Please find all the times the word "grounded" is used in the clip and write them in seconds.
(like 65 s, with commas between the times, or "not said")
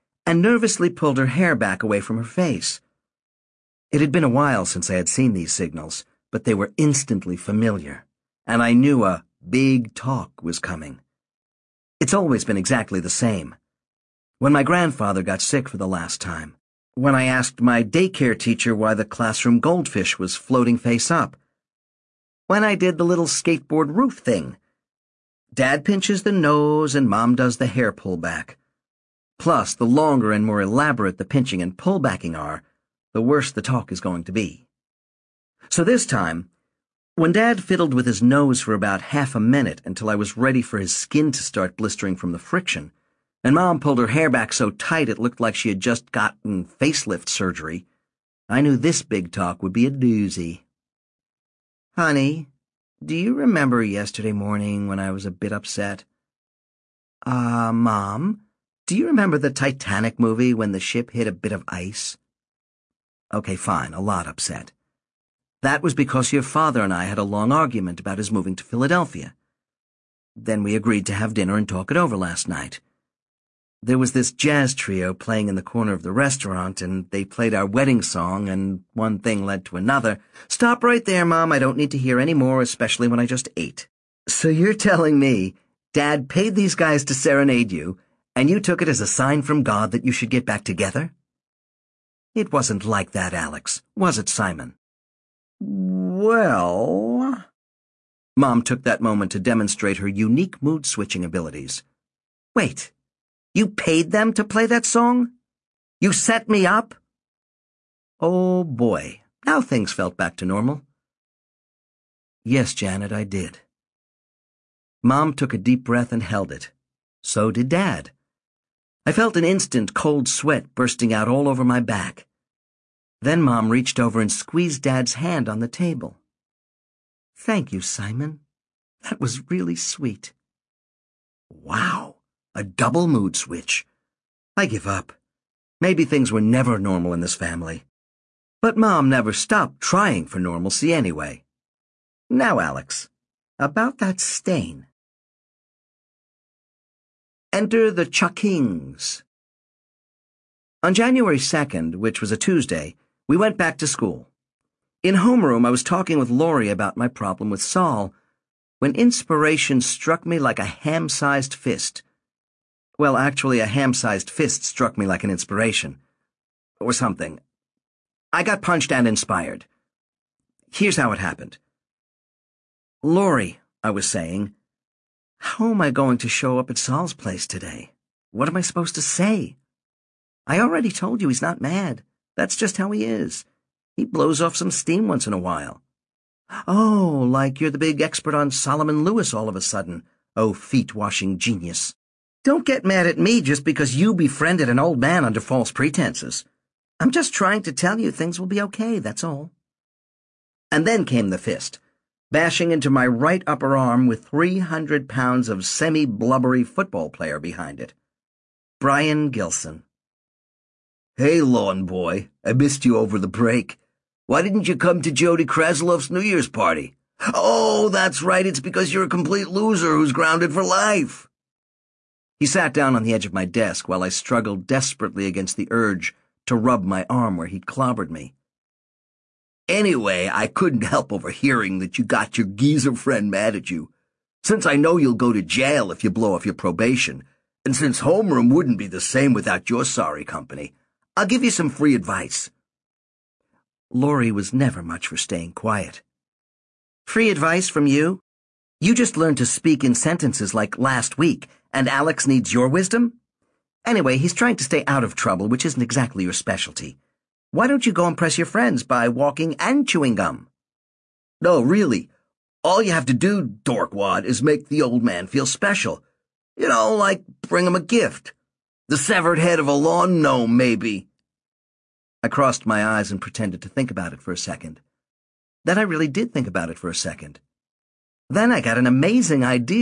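220 s.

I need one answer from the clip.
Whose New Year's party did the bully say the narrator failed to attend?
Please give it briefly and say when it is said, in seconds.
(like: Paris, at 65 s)
Jody Kraslov, at 215 s.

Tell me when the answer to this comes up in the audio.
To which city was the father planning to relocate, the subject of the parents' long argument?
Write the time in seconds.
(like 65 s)
68 s.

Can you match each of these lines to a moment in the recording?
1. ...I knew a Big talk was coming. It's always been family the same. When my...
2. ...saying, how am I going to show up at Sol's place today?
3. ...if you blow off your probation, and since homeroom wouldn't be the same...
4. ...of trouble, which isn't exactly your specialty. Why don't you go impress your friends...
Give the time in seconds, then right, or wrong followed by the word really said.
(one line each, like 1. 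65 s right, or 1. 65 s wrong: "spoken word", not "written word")
1. 8 s wrong: "exactly", not "family"
2. 174 s right
3. 235 s right
4. 255 s right.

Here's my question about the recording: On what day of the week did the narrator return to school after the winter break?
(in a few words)
Tuesday.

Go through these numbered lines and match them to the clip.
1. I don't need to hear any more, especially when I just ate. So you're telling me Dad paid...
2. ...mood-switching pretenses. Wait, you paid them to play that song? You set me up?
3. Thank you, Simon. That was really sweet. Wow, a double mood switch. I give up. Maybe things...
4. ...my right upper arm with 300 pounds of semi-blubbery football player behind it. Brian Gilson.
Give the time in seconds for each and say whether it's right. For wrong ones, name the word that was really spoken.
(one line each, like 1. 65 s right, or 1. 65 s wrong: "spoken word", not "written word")
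1. 81 s right
2. 100 s wrong: "abilities", not "pretenses"
3. 127 s right
4. 202 s right.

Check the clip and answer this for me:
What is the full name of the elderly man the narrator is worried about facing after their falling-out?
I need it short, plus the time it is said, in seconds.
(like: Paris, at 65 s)
Solomon Lewis, at 188 s.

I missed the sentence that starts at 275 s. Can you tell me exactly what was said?
Then I really did think about it for a second.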